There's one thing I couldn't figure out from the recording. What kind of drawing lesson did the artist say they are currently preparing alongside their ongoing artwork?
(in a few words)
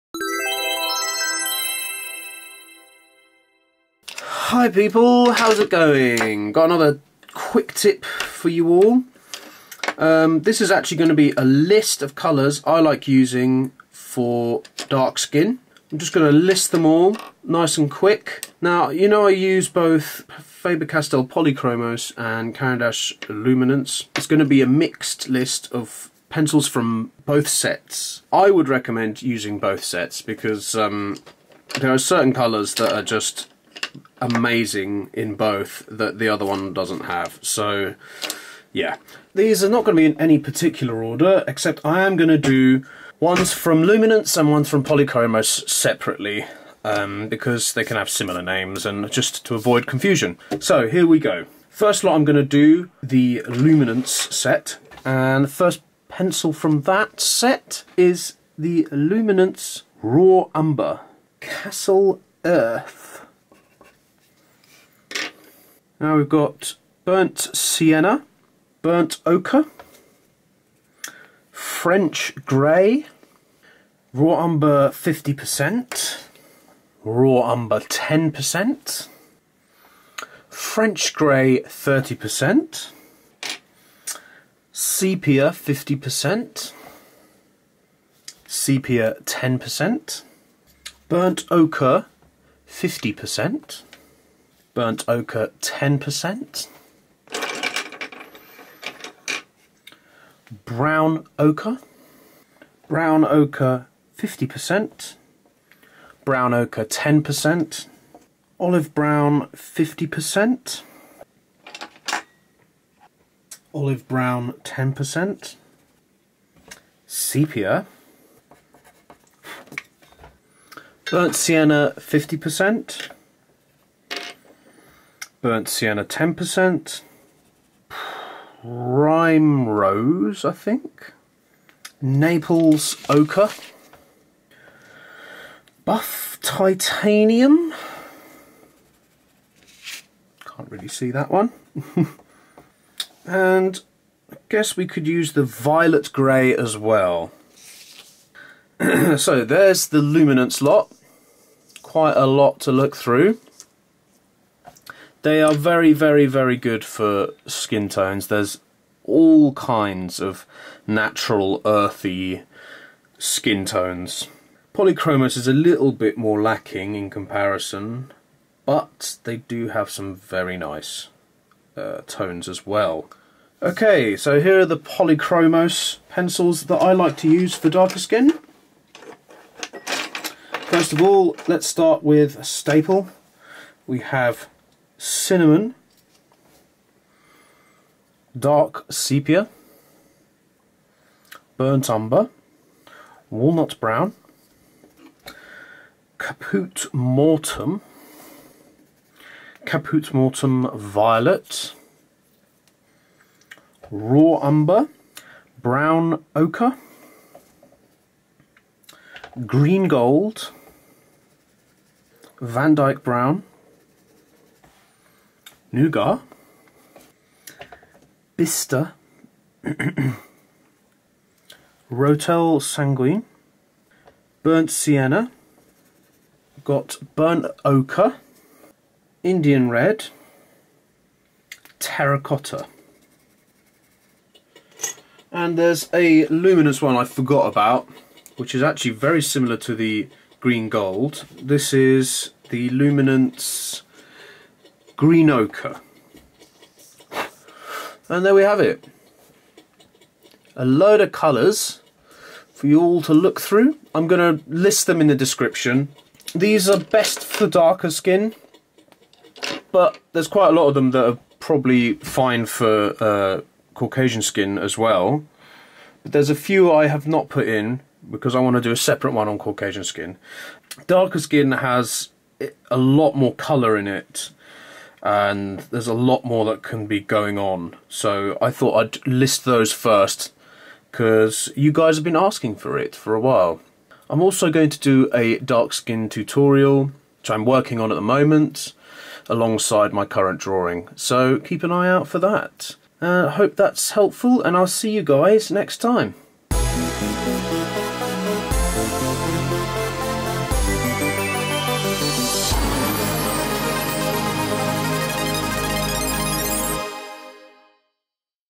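Dark skin tutorial.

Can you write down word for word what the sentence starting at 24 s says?
It's going to be a mixed list of pencils from both sets.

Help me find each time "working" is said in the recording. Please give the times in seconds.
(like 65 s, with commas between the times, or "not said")
287 s.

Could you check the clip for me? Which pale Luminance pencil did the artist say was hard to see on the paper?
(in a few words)
Buff Titanium.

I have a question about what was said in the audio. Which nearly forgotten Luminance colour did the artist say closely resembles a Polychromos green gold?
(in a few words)
Green Ochre.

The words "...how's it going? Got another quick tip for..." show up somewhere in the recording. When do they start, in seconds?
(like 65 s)
5 s.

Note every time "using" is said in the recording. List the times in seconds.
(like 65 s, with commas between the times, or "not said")
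13 s, 29 s.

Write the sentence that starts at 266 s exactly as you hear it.
But there's a few I have not put in because I want to do a separate one on Caucasian skin.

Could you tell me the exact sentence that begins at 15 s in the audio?
I'm just going to list them all, nice and quick.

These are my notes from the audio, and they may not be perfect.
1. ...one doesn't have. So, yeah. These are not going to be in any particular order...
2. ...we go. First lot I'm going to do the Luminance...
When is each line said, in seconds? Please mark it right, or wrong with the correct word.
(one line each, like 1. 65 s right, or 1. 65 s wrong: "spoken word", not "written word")
1. 36 s right
2. 51 s right.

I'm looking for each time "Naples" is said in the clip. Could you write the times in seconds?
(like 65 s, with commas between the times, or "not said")
131 s.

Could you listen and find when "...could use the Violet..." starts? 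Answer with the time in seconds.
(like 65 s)
144 s.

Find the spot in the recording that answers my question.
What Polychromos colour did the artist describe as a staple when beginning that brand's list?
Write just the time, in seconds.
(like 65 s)
185 s.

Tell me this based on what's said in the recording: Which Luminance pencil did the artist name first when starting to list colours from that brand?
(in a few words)
Raw Umber Cassel Earth.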